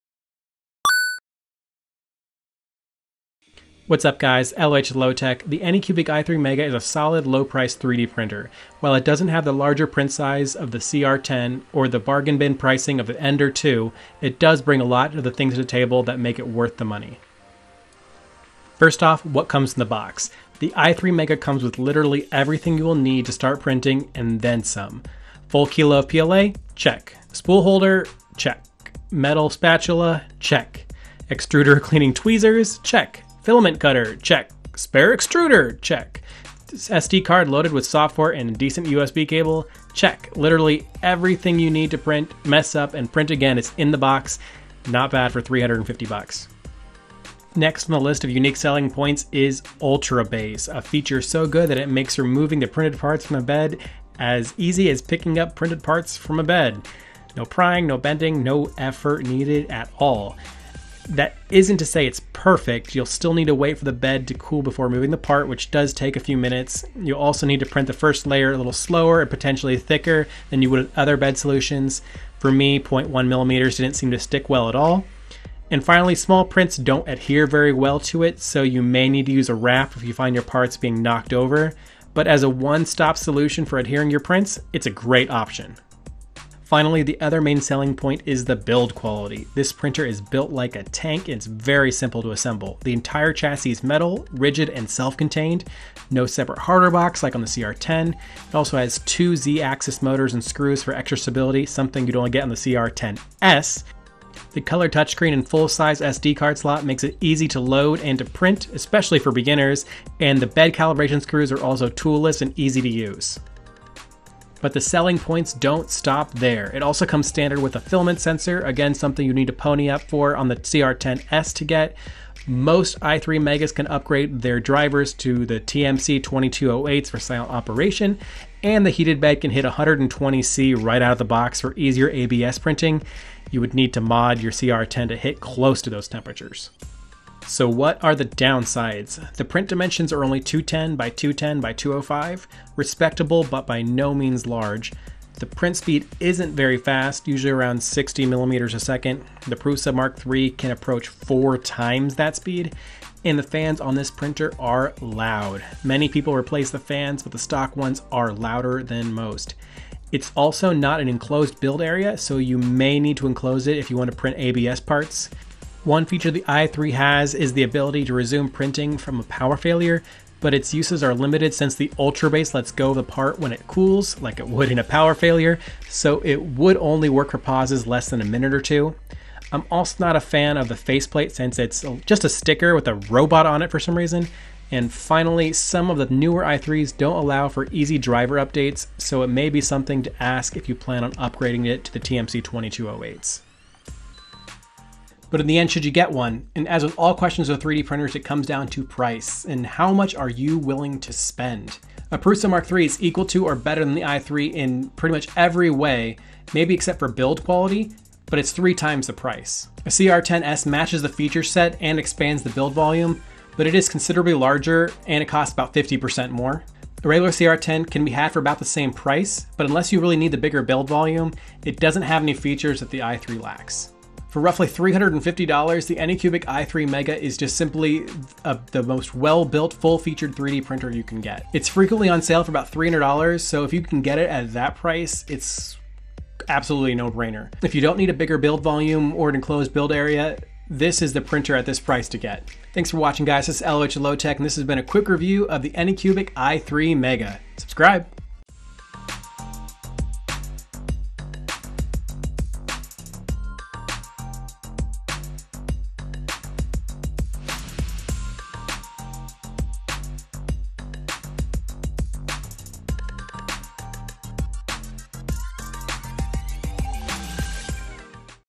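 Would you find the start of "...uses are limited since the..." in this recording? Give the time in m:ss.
2:50.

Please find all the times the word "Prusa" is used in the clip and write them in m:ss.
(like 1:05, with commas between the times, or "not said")
2:29, 3:22.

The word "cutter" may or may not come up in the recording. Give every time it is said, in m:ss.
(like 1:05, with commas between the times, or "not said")
0:33.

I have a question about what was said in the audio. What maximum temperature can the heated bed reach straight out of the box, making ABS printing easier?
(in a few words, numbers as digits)
120C.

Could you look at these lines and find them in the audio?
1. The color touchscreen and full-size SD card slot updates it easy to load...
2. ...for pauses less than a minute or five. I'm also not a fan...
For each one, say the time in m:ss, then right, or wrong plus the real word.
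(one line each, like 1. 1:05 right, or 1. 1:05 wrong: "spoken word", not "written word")
1. 1:44 wrong: "makes", not "updates"
2. 2:57 wrong: "two", not "five".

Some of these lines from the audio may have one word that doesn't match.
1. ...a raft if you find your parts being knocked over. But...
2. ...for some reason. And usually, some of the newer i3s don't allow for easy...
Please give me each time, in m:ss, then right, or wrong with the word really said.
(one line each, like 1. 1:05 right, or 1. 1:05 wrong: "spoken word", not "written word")
1. 1:19 right
2. 3:03 wrong: "finally", not "usually".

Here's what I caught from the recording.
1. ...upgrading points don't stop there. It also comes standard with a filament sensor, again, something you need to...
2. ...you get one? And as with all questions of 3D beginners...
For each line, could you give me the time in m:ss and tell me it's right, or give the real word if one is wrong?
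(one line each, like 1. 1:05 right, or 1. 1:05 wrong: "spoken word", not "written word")
1. 1:54 wrong: "selling", not "upgrading"
2. 3:15 wrong: "printers", not "beginners".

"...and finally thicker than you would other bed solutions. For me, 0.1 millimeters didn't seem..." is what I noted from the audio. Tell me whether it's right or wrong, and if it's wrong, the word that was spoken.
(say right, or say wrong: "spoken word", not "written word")
wrong: "potentially", not "finally".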